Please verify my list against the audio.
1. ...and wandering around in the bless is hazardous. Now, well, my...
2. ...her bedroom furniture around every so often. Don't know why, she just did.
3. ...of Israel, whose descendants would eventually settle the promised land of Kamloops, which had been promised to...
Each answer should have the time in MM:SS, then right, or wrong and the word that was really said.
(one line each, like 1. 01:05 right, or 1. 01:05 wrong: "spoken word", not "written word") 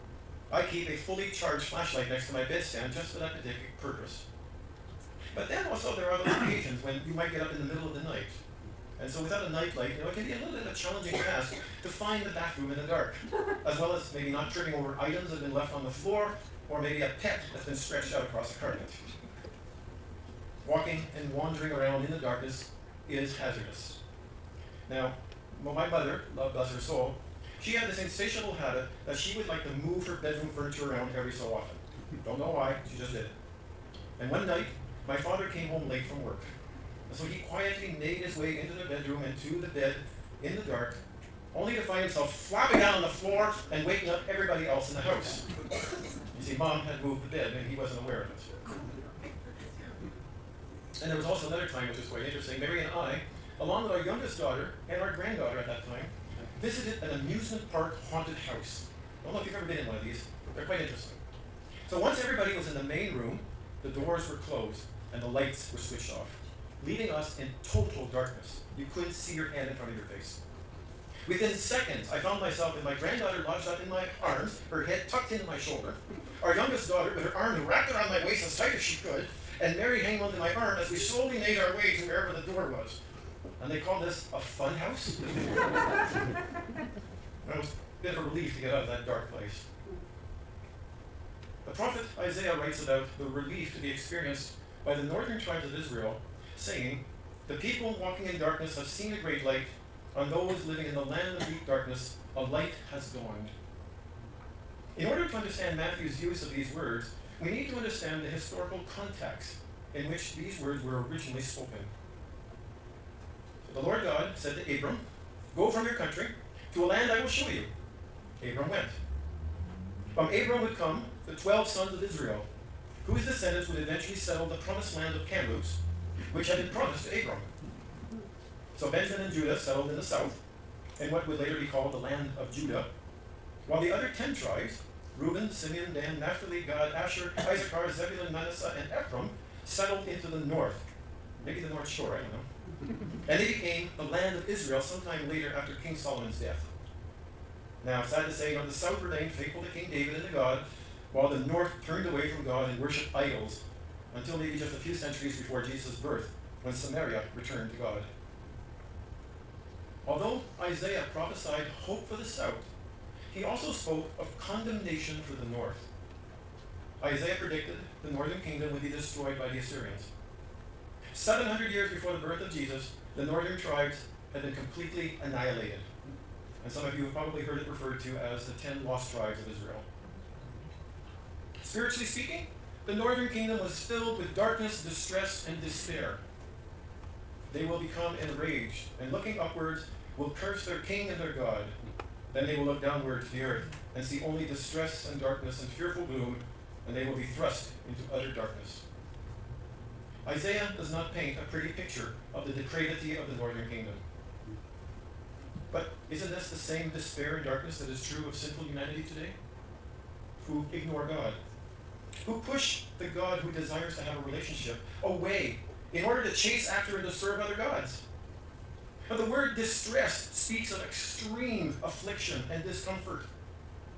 1. 00:21 wrong: "darkness", not "bless"
2. 00:30 right
3. 02:01 right.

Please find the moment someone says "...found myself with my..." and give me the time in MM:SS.
01:12.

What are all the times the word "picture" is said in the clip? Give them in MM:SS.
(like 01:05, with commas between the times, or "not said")
03:21.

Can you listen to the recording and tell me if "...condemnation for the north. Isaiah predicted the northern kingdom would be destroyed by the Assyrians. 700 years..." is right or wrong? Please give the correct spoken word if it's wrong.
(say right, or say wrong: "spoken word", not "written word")
right.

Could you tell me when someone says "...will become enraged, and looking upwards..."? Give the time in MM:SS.
03:07.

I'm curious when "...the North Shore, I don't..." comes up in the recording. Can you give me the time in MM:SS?
02:21.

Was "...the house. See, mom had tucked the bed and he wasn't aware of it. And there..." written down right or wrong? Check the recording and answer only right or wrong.
wrong.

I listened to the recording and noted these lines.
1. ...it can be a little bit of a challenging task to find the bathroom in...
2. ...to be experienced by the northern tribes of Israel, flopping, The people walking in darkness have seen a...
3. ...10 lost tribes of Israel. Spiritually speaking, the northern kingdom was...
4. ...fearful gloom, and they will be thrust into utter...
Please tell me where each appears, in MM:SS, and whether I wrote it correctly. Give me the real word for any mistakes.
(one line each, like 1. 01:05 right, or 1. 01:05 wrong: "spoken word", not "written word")
1. 00:10 right
2. 01:33 wrong: "saying", not "flopping"
3. 02:58 right
4. 03:15 right.